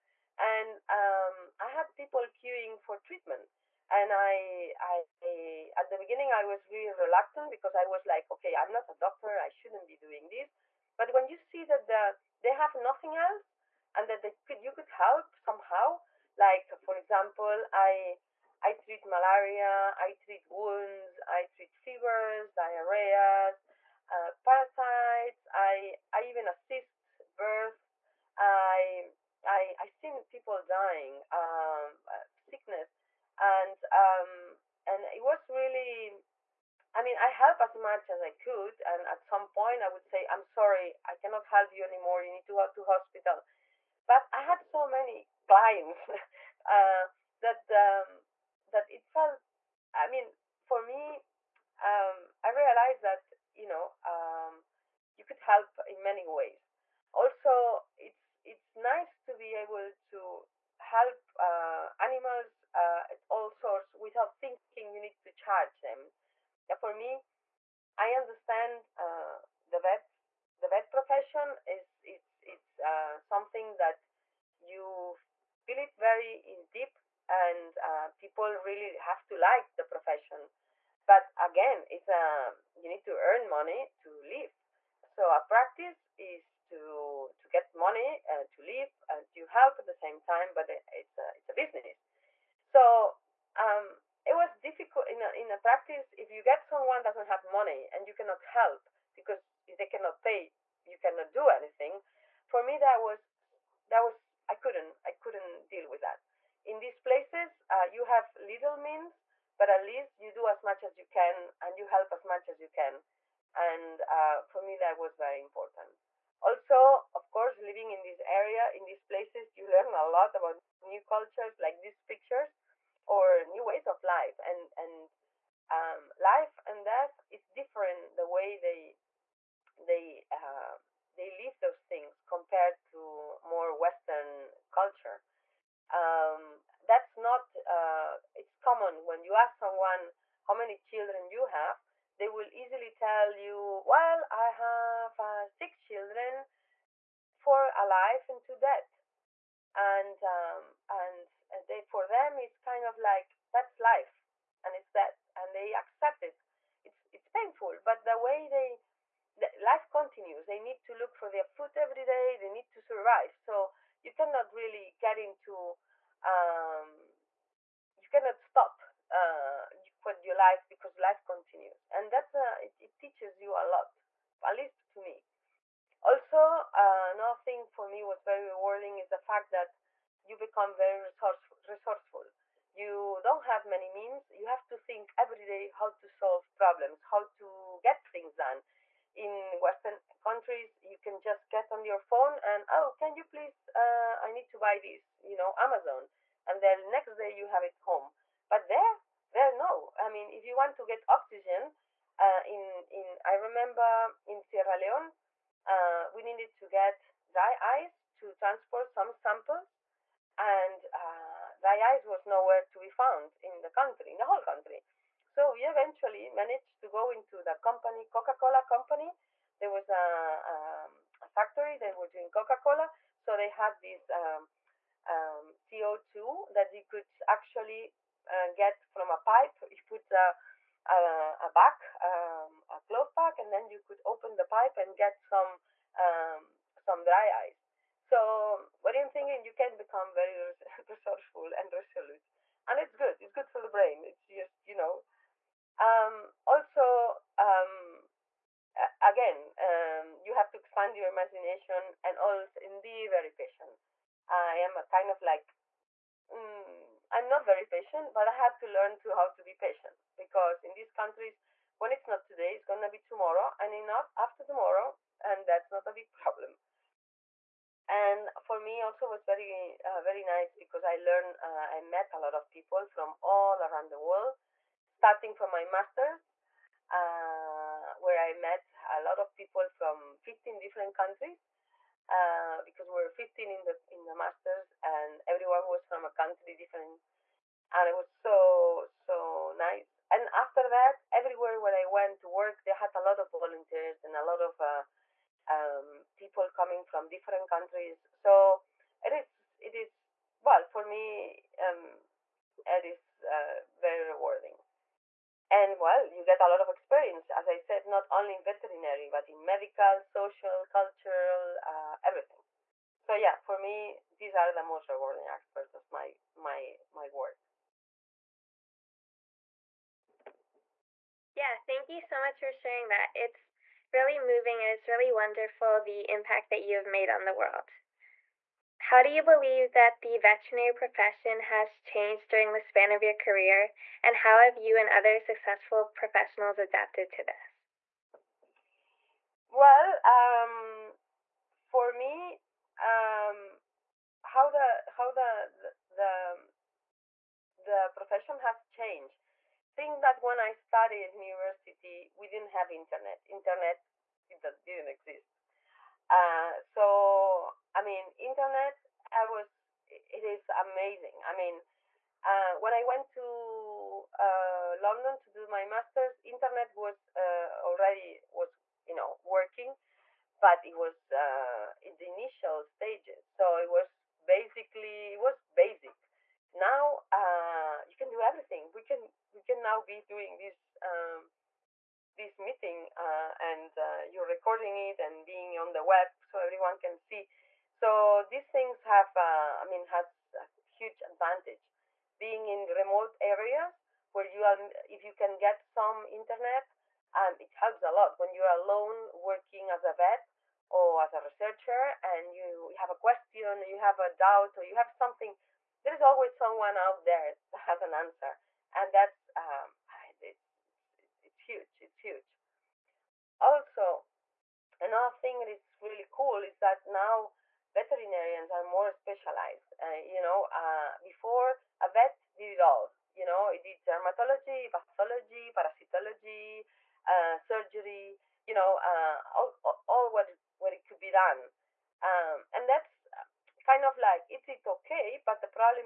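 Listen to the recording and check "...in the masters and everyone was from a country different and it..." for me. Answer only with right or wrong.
right.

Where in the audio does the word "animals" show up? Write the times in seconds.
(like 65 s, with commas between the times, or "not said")
62 s.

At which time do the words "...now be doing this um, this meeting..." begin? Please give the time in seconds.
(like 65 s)
379 s.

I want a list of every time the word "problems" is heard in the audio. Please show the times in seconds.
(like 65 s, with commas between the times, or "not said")
186 s, 266 s.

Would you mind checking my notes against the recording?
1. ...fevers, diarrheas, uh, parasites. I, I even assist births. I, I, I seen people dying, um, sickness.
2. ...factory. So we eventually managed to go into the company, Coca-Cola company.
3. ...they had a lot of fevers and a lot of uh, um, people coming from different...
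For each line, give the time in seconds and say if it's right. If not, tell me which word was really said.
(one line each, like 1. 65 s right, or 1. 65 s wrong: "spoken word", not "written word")
1. 21 s right
2. 214 s wrong: "country", not "factory"
3. 292 s wrong: "volunteers", not "fevers".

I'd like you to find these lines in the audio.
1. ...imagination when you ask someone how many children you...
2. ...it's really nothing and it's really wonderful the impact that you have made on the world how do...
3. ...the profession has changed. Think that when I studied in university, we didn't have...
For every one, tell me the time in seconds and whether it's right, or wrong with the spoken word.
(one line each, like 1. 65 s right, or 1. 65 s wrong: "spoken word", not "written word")
1. 138 s wrong: "common", not "imagination"
2. 323 s wrong: "moving", not "nothing"
3. 347 s right.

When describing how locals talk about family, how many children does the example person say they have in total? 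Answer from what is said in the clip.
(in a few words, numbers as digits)
6.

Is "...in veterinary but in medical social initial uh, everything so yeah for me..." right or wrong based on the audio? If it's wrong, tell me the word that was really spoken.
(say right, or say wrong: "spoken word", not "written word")
wrong: "cultural", not "initial".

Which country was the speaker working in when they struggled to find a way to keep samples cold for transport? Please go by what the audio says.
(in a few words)
Sierra Leone.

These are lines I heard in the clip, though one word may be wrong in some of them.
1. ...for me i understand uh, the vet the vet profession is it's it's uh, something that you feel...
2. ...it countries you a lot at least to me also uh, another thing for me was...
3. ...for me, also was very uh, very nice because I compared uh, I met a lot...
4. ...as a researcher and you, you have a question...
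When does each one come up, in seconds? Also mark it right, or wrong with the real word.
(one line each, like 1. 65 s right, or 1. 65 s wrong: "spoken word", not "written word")
1. 66 s right
2. 172 s wrong: "teaches", not "countries"
3. 268 s wrong: "learned", not "compared"
4. 401 s right.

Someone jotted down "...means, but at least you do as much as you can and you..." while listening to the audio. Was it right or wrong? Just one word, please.
right.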